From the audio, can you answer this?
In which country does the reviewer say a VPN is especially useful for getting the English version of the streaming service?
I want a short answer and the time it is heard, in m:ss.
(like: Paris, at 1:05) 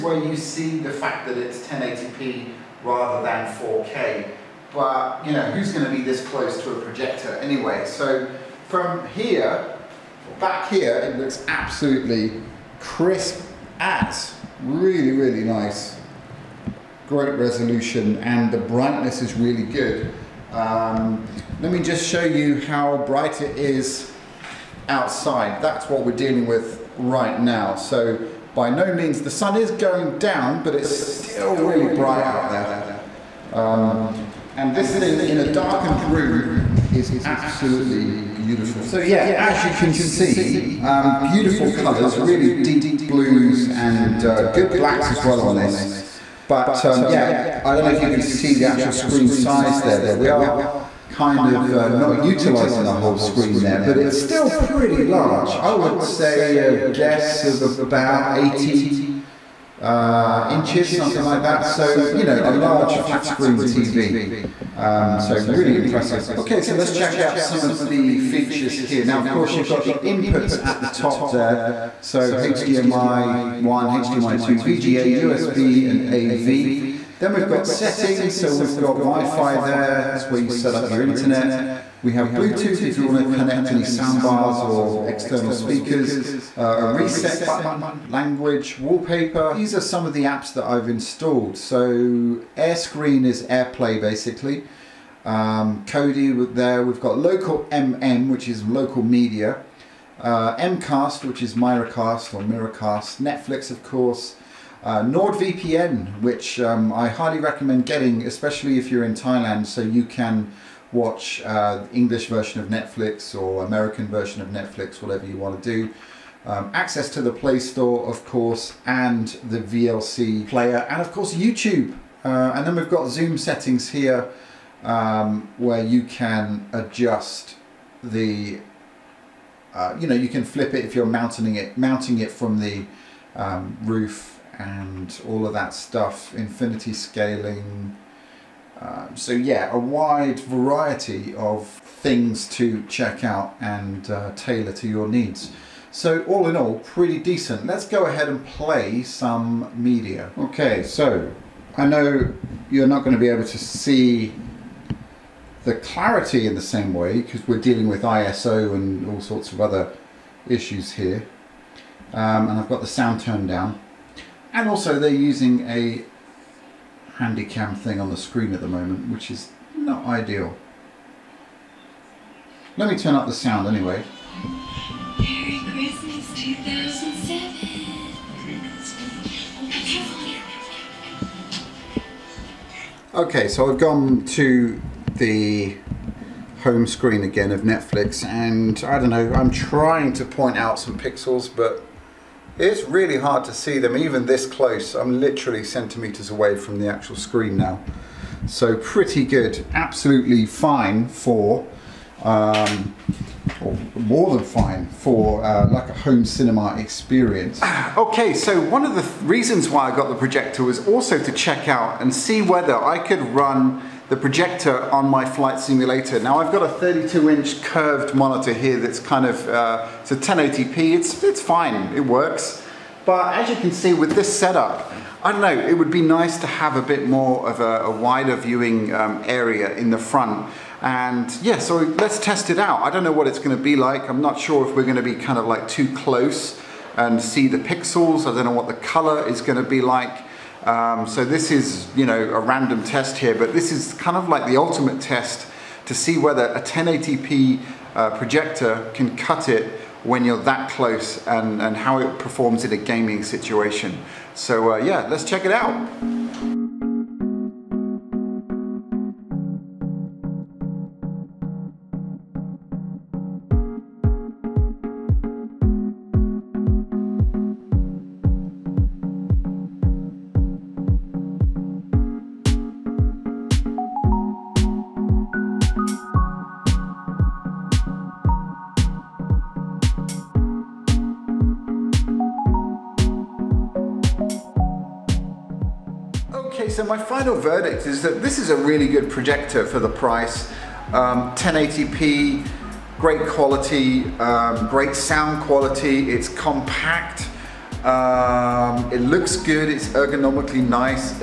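Thailand, at 1:49.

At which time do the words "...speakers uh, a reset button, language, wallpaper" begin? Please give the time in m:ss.
1:25.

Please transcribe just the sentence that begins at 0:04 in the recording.
But, you know, who's going to be this close to a projector anyway?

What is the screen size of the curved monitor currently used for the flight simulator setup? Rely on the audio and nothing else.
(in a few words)
32 inch.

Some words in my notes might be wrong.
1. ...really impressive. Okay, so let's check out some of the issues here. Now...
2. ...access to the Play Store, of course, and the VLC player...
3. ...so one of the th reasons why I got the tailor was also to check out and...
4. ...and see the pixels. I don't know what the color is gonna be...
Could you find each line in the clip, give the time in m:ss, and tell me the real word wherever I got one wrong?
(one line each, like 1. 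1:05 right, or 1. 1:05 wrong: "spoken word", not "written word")
1. 1:05 wrong: "features", not "issues"
2. 1:56 right
3. 3:28 wrong: "projector", not "tailor"
4. 3:56 right.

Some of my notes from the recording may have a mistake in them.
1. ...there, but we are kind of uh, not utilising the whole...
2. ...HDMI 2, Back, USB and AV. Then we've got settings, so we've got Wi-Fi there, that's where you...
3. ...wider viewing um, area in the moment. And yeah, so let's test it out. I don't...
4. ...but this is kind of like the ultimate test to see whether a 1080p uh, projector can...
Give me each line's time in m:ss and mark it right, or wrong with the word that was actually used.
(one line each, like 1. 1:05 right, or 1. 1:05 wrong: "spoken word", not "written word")
1. 0:49 right
2. 1:13 wrong: "VGA", not "Back"
3. 3:48 wrong: "front", not "moment"
4. 4:03 right.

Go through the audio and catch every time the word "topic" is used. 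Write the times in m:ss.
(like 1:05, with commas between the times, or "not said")
not said.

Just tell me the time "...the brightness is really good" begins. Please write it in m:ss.
0:18.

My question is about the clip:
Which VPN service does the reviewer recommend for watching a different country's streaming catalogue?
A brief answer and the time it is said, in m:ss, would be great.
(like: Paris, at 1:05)
NordVPN, at 1:45.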